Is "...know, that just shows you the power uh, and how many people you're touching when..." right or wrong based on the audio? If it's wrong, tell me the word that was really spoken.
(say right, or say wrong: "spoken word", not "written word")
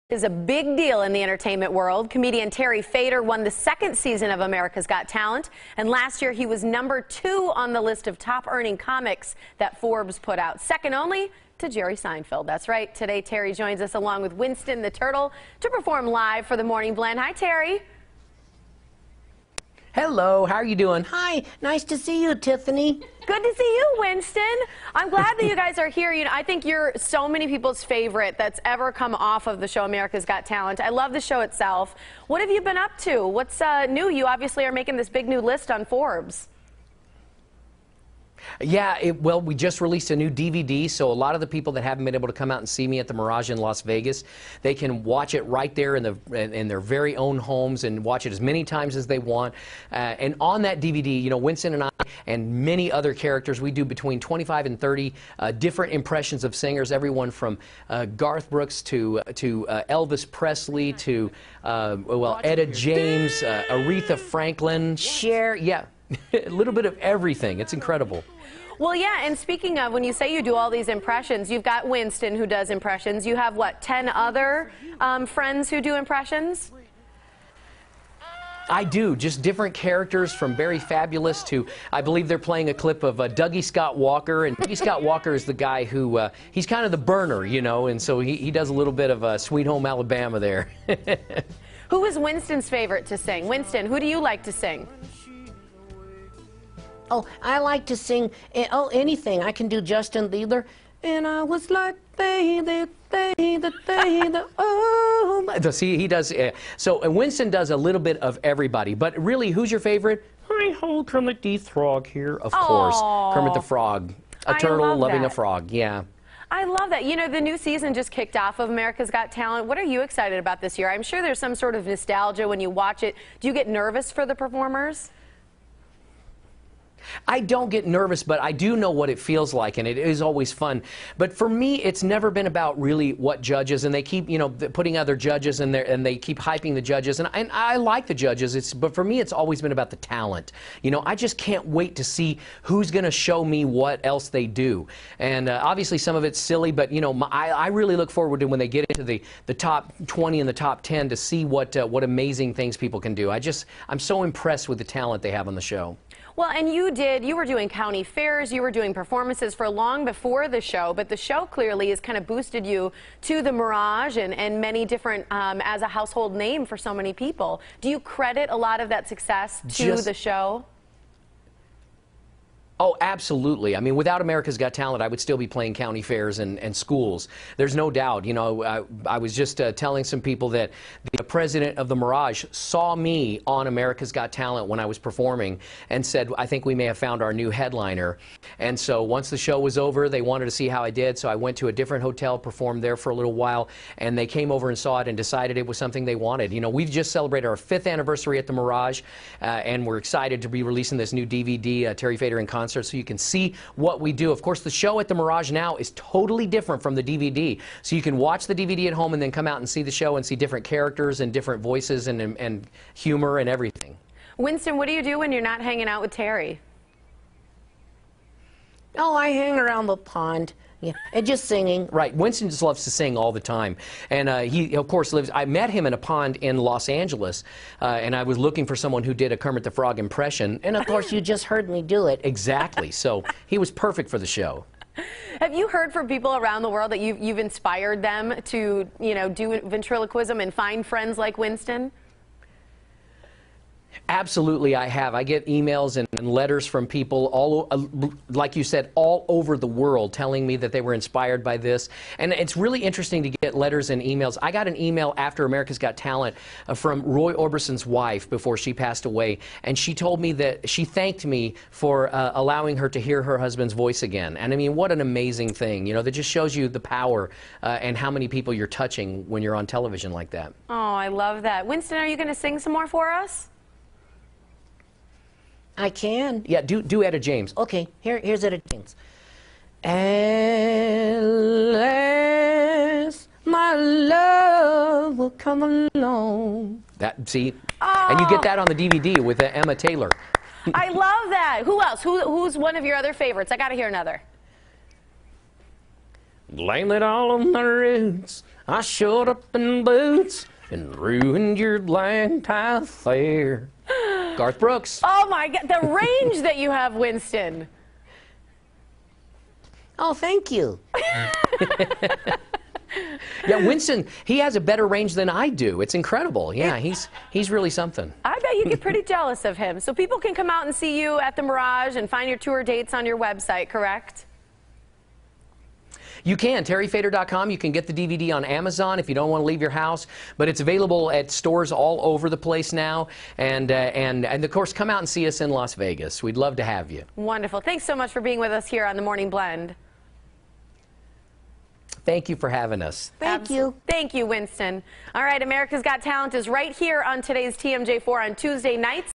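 right.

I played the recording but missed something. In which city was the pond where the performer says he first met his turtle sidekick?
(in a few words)
Los Angeles.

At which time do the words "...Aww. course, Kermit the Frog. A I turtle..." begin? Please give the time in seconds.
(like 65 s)
112 s.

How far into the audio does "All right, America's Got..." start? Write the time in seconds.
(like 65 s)
345 s.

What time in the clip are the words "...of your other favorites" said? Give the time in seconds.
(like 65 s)
292 s.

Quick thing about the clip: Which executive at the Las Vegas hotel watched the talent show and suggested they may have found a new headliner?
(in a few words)
The president of the Mirage.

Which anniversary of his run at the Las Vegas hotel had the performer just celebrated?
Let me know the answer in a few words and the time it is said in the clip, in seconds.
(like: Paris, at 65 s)
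5th, at 197 s.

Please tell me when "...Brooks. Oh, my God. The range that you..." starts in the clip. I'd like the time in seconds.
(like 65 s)
304 s.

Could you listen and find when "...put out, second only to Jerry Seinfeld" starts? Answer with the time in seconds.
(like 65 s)
10 s.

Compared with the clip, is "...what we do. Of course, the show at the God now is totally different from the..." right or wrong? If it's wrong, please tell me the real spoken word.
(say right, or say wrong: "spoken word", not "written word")
wrong: "Mirage", not "God".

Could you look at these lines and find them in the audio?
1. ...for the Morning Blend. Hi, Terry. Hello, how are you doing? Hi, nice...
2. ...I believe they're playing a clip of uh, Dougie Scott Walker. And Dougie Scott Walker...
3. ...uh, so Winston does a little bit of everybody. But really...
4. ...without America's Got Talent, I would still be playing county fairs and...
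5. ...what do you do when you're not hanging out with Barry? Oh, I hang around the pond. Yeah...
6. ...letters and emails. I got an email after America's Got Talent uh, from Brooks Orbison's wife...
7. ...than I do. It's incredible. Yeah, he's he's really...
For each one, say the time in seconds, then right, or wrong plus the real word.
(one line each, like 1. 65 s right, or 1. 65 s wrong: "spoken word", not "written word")
1. 16 s right
2. 81 s right
3. 106 s right
4. 173 s right
5. 214 s wrong: "Terry", not "Barry"
6. 253 s wrong: "Roy", not "Brooks"
7. 315 s right.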